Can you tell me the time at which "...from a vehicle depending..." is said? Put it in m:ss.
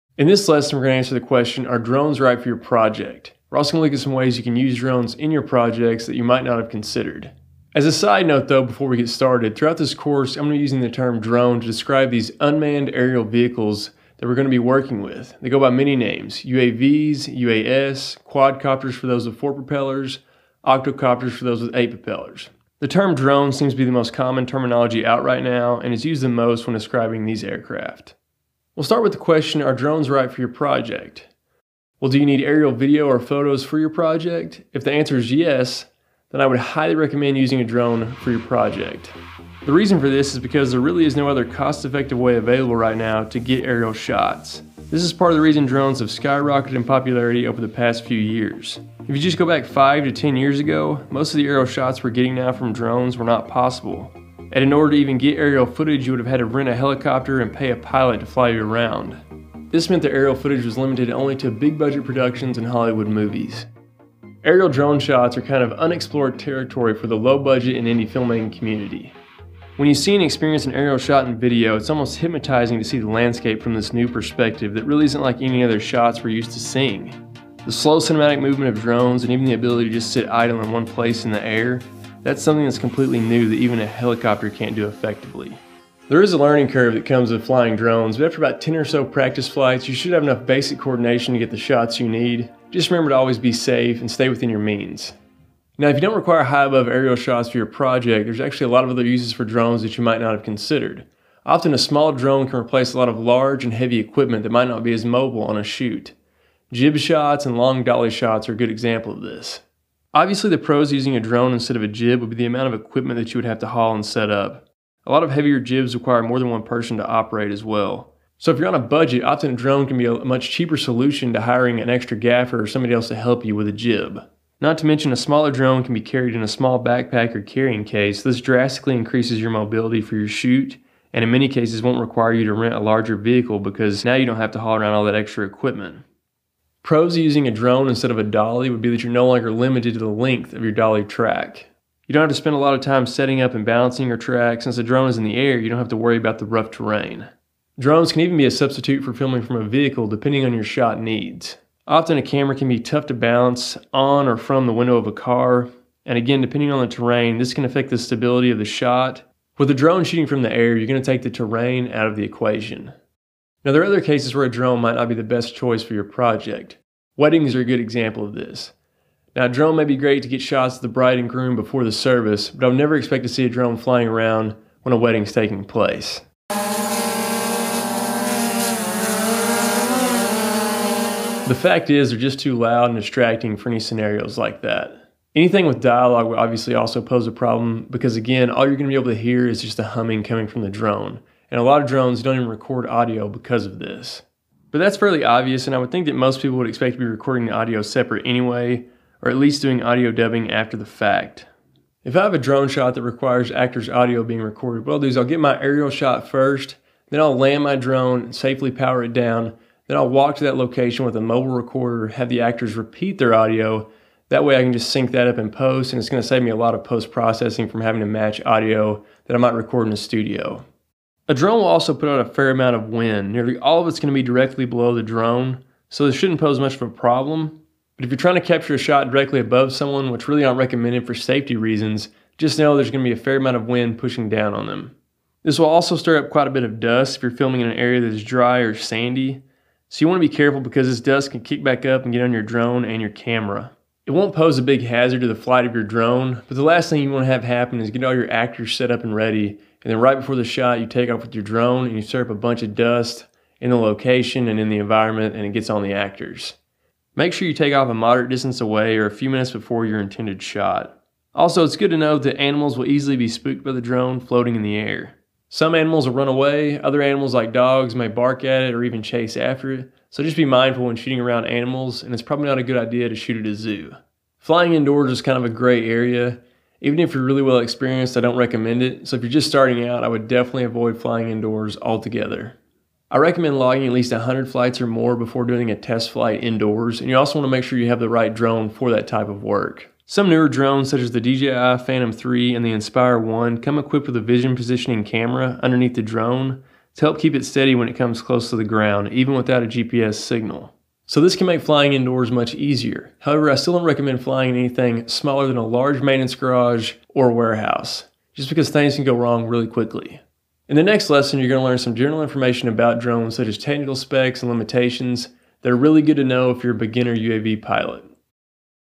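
2:29.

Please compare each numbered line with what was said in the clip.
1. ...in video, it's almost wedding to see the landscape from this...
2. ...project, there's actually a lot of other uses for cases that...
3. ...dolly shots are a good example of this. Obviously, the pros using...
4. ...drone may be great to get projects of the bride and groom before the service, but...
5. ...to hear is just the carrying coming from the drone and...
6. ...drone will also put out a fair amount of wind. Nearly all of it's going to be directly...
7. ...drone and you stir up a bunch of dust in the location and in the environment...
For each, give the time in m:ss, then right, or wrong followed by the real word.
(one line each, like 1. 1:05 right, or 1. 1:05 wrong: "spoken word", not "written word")
1. 1:11 wrong: "hypnotizing", not "wedding"
2. 1:37 wrong: "drones", not "cases"
3. 1:47 right
4. 2:49 wrong: "shots", not "projects"
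5. 3:09 wrong: "humming", not "carrying"
6. 3:41 right
7. 4:11 right.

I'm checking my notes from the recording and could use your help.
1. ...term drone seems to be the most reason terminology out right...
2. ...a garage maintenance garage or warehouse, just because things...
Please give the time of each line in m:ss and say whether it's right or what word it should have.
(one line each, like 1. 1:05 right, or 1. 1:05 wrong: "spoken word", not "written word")
1. 0:22 wrong: "common", not "reason"
2. 5:05 wrong: "large", not "garage".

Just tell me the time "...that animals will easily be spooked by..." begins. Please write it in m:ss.
4:22.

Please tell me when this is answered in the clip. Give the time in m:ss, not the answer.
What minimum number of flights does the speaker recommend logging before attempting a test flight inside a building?
4:44.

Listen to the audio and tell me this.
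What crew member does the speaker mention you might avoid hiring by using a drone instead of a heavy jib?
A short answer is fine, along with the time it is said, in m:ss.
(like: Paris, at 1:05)
gaffer, at 2:02.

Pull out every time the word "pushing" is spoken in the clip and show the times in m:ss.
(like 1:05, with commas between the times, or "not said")
3:53.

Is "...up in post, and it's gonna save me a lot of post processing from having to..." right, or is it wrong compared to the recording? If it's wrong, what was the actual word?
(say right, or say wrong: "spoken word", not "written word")
right.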